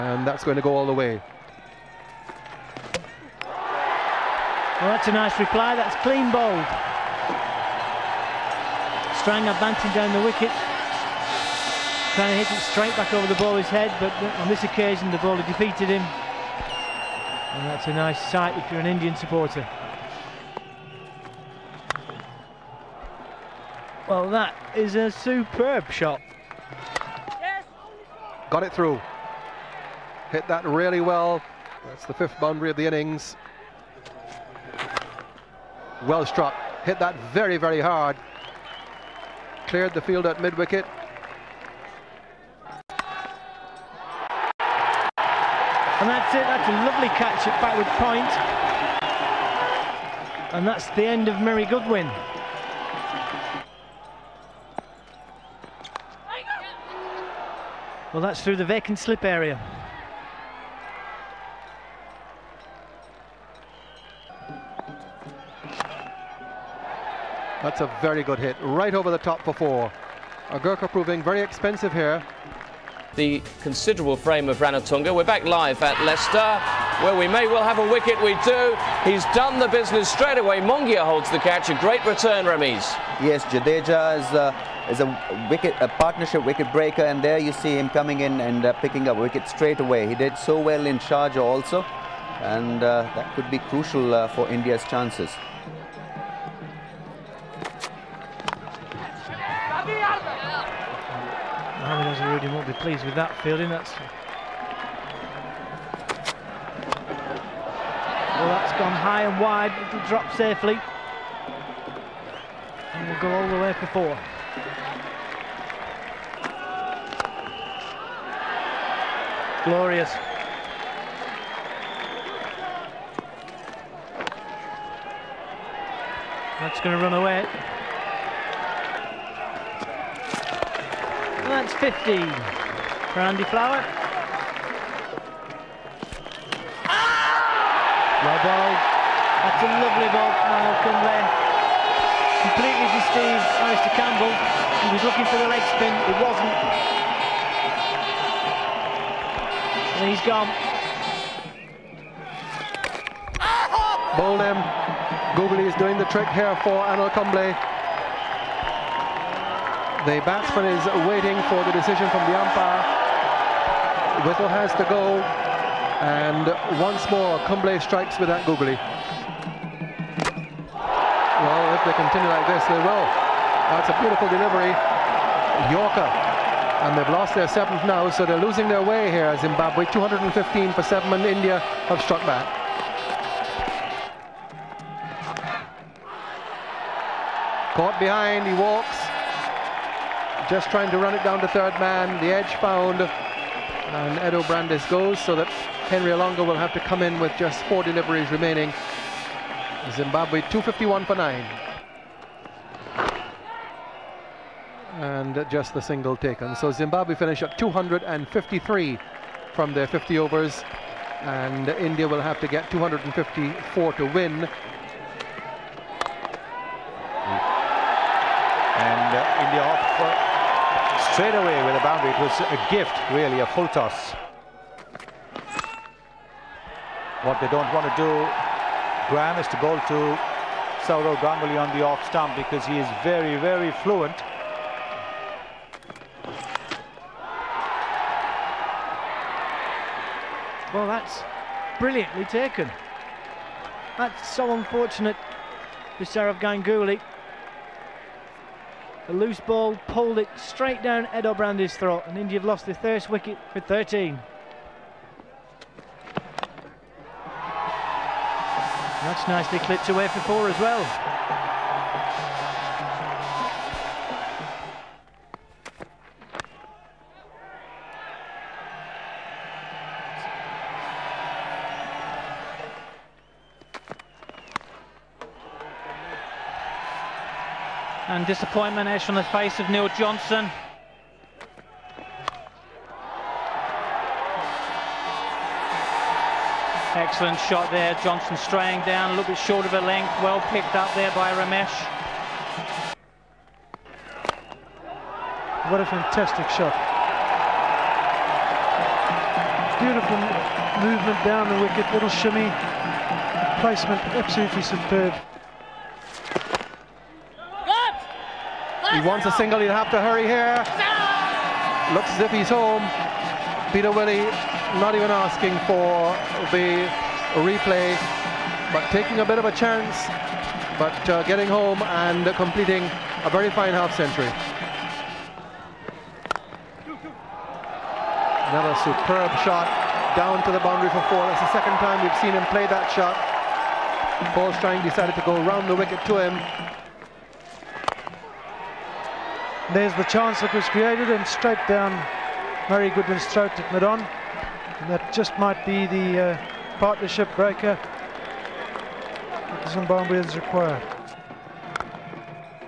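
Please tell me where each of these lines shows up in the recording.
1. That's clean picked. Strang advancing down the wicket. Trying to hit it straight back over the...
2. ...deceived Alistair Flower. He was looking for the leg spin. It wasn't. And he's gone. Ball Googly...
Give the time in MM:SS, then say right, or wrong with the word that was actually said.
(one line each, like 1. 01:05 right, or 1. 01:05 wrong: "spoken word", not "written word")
1. 00:05 wrong: "bowled", not "picked"
2. 02:22 wrong: "Campbell", not "Flower".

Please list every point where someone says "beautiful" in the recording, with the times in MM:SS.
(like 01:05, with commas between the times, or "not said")
02:54, 04:59.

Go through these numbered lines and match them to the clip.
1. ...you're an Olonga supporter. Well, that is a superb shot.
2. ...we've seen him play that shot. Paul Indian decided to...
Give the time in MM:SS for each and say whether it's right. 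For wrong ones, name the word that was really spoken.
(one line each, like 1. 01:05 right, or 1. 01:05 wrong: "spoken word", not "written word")
1. 00:18 wrong: "Indian", not "Olonga"
2. 05:31 wrong: "Strang", not "Indian".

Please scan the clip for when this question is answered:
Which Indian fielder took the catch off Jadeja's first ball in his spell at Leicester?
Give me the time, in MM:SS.
01:20.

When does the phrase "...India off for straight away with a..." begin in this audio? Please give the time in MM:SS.
03:39.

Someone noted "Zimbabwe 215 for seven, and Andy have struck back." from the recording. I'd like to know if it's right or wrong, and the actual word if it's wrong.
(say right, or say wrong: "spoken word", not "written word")
wrong: "India", not "Andy".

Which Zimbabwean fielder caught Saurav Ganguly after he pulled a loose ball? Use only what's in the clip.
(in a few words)
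Eddo Brandes.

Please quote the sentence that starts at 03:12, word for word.
The edge found, and Eddo Brandes goes so that Henry Olonga will have to come in with just four deliveries remaining.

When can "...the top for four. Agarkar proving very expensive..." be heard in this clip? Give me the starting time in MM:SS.
01:09.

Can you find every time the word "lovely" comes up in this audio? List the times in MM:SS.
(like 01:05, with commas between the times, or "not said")
00:46, 02:19.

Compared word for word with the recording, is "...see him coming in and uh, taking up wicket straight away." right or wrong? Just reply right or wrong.
wrong.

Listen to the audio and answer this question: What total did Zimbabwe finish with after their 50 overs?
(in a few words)
253.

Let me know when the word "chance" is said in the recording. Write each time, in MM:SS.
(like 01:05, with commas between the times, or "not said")
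01:34, 05:19, 05:40.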